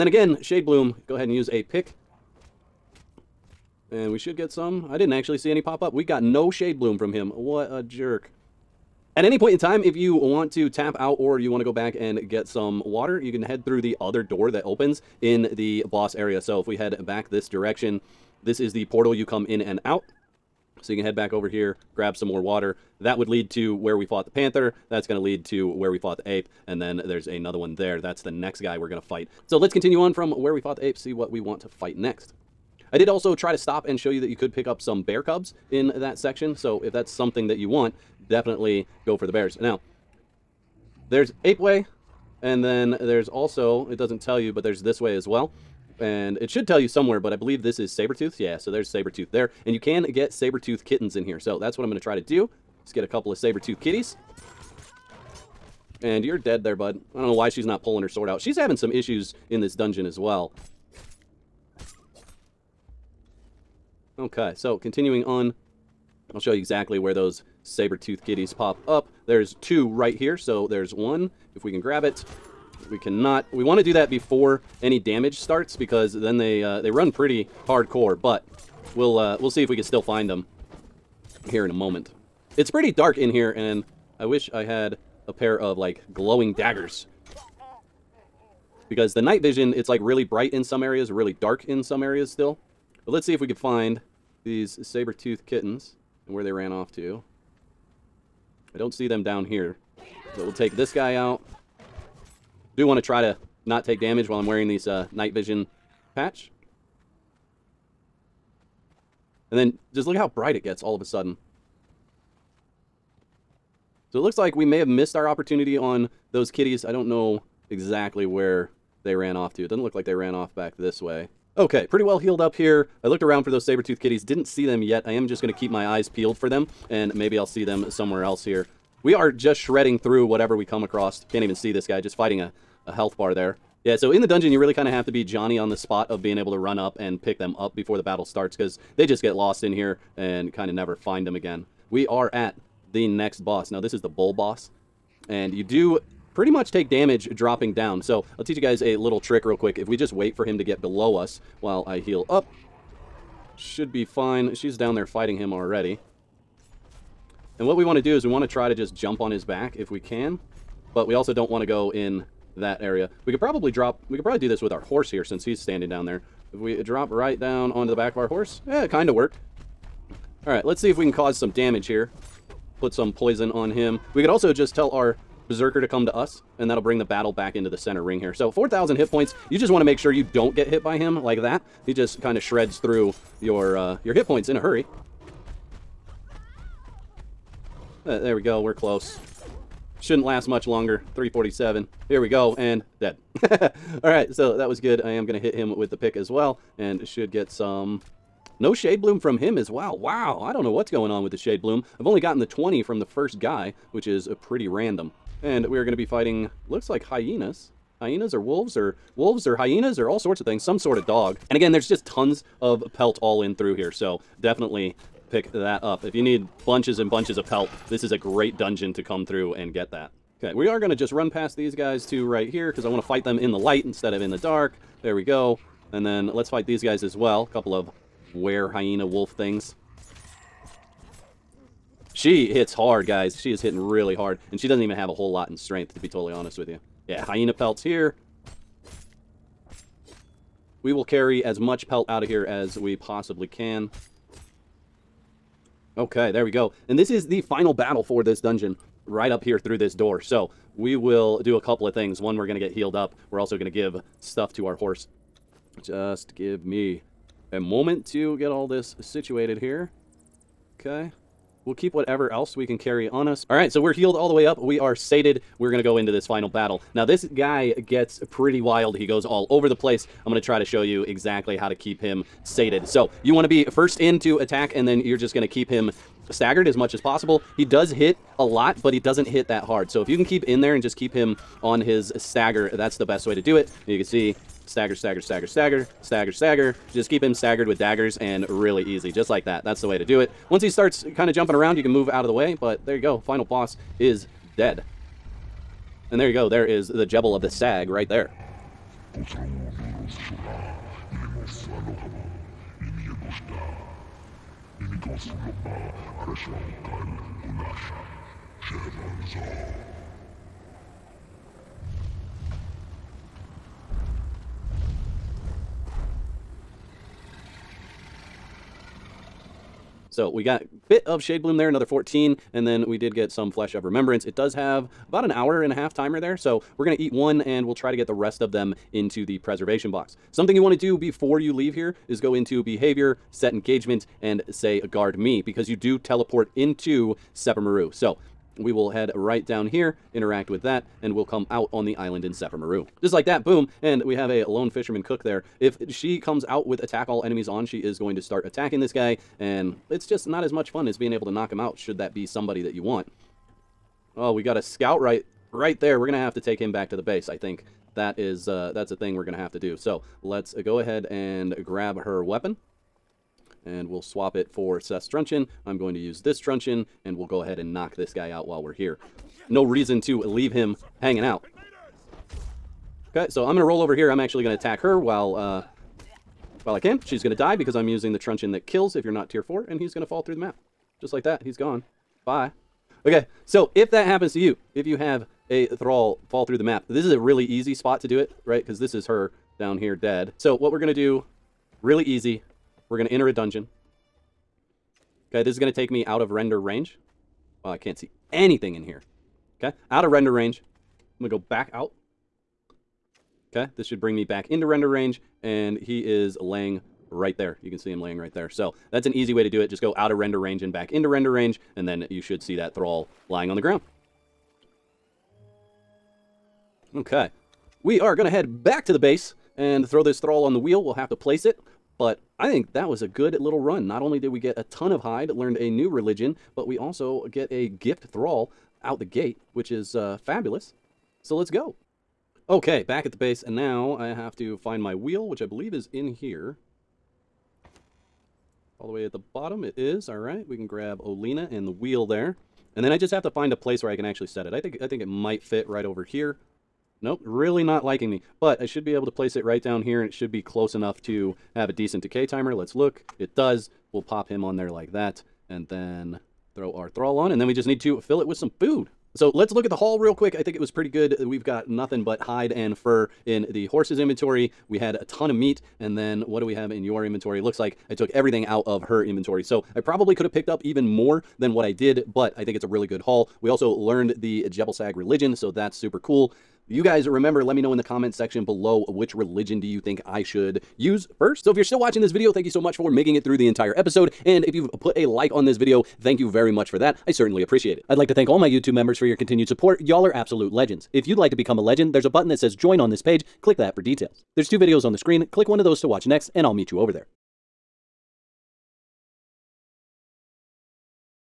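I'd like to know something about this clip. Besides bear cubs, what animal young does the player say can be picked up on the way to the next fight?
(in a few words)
Saber tooth kittens.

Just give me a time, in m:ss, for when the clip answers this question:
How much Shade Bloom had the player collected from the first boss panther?
3:22.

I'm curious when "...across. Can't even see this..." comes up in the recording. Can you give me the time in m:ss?
2:10.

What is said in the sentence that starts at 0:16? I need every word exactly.
So if we head back this direction, this is the portal you come in and out.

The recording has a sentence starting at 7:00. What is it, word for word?
We'll have to place it, but I think that was a good little run.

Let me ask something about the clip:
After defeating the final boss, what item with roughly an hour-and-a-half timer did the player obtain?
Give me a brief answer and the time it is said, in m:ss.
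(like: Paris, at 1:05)
Flesh of Remembrance, at 5:23.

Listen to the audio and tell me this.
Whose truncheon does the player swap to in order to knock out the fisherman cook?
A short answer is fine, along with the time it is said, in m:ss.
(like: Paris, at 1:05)
Seth's, at 6:04.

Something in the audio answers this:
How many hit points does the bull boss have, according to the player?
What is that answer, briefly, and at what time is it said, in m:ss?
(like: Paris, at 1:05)
4,000, at 2:58.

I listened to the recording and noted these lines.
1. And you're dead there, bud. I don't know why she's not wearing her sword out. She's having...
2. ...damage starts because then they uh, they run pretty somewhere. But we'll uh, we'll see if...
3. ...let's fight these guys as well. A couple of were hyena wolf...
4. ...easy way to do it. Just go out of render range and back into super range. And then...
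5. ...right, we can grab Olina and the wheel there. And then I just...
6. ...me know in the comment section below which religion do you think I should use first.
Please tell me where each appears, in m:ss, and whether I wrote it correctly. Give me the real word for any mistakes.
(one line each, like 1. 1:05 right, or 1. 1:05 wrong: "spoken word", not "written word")
1. 0:56 wrong: "pulling", not "wearing"
2. 1:14 wrong: "hardcore", not "somewhere"
3. 3:46 right
4. 6:49 wrong: "render", not "super"
5. 7:20 right
6. 7:57 right.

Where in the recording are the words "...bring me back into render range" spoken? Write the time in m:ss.
6:44.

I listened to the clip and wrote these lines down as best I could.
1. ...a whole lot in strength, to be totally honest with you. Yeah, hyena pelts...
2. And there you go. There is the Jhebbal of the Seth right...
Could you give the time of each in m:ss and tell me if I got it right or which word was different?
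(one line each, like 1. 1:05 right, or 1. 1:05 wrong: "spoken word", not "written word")
1. 3:55 right
2. 4:56 wrong: "Sag", not "Seth".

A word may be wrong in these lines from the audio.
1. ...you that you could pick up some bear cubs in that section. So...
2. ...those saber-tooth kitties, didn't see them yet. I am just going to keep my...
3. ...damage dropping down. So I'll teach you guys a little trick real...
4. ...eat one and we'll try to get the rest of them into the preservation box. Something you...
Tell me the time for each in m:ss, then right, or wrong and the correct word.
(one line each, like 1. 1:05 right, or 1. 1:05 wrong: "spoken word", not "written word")
1. 0:34 right
2. 2:03 right
3. 2:26 right
4. 5:27 right.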